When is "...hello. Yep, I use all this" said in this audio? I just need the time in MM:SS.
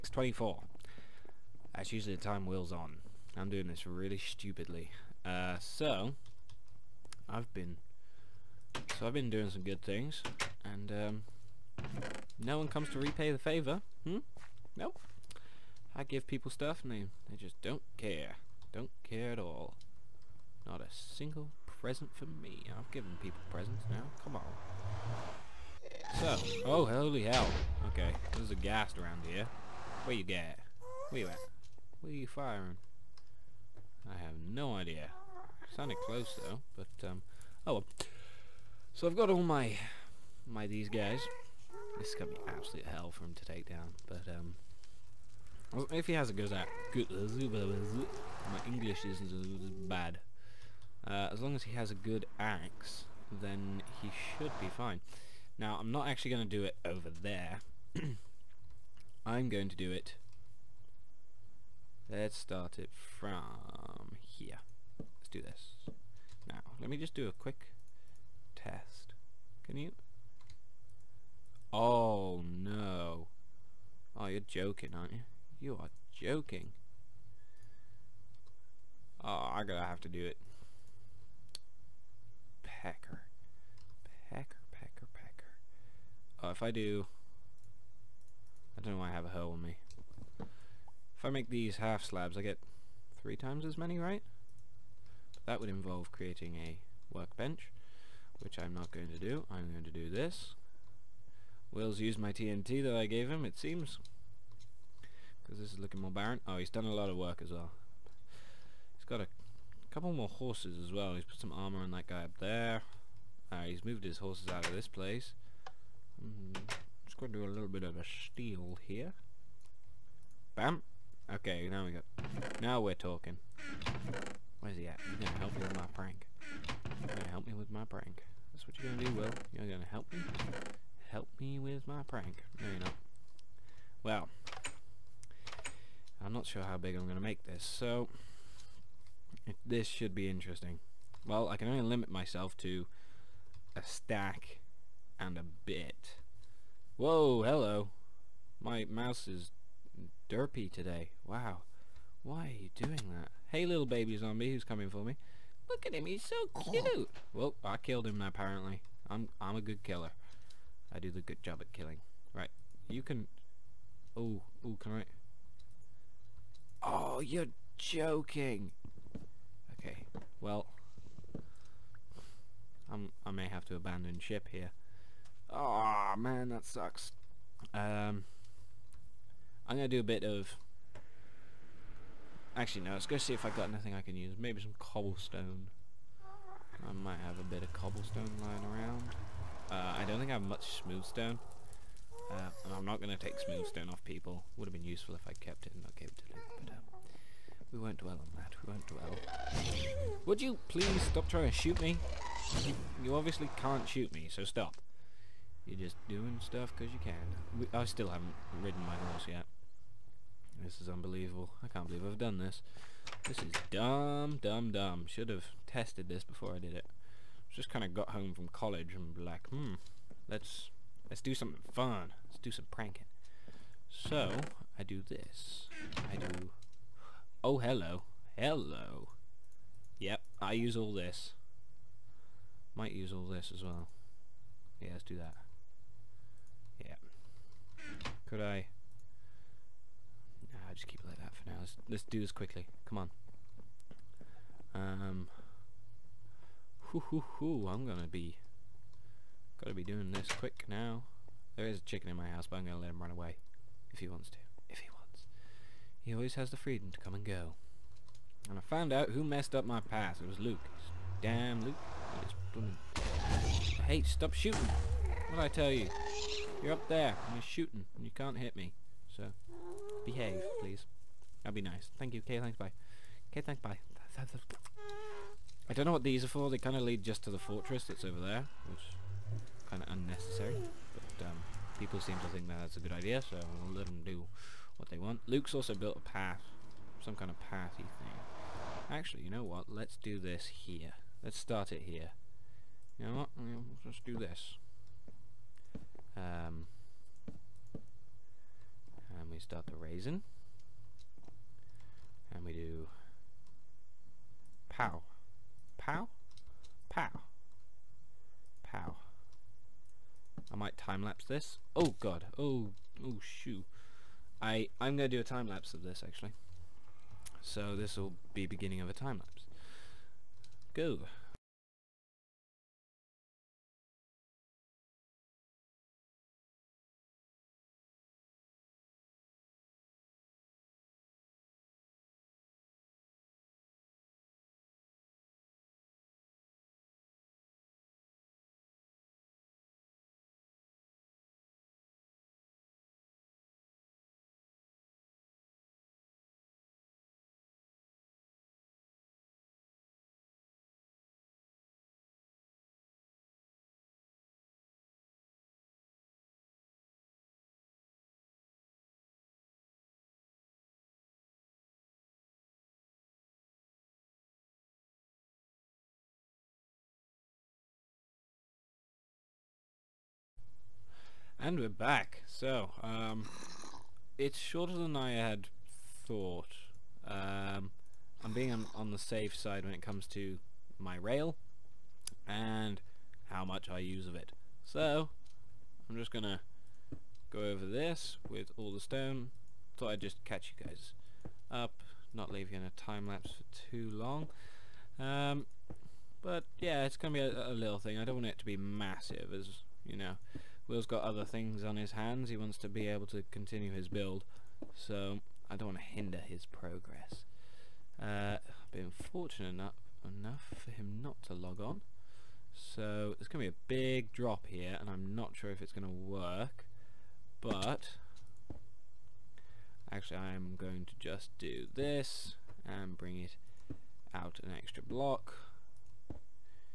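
03:48.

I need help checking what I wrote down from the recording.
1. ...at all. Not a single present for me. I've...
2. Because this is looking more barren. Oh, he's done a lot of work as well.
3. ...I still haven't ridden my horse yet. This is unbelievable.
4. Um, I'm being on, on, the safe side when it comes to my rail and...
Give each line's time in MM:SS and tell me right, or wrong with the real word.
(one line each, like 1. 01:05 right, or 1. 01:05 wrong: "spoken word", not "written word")
1. 00:19 right
2. 01:45 right
3. 03:27 right
4. 06:17 right.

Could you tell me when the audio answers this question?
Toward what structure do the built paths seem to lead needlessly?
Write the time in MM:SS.
04:37.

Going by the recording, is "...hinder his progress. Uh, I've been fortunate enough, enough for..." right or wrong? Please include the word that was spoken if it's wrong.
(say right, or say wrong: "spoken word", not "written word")
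right.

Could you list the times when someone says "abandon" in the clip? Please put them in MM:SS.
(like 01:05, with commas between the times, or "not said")
02:53.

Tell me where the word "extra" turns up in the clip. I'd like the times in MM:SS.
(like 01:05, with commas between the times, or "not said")
07:04.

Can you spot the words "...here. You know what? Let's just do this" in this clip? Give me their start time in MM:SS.
04:51.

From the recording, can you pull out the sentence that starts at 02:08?
That's what you're gonna do, Will.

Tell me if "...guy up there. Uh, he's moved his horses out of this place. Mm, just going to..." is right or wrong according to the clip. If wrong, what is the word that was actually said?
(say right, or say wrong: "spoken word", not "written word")
right.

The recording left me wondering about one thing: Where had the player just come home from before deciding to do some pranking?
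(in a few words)
college.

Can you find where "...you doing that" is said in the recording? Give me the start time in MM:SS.
02:32.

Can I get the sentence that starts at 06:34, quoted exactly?
Um, but yeah, it's going to be a, a little thing.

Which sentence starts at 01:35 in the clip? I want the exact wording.
But that would involve creating a workbench, which I'm not going to do.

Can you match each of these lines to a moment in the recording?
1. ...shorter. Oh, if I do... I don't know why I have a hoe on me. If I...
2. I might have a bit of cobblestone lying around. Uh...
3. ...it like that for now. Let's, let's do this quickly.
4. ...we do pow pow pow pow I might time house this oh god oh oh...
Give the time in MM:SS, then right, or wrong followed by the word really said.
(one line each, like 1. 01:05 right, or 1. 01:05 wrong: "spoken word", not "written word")
1. 01:25 wrong: "pecker", not "shorter"
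2. 03:06 right
3. 04:01 right
4. 05:02 wrong: "lapse", not "house".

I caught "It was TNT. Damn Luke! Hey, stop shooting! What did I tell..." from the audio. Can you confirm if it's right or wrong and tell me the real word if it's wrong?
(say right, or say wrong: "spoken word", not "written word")
wrong: "Luke", not "TNT".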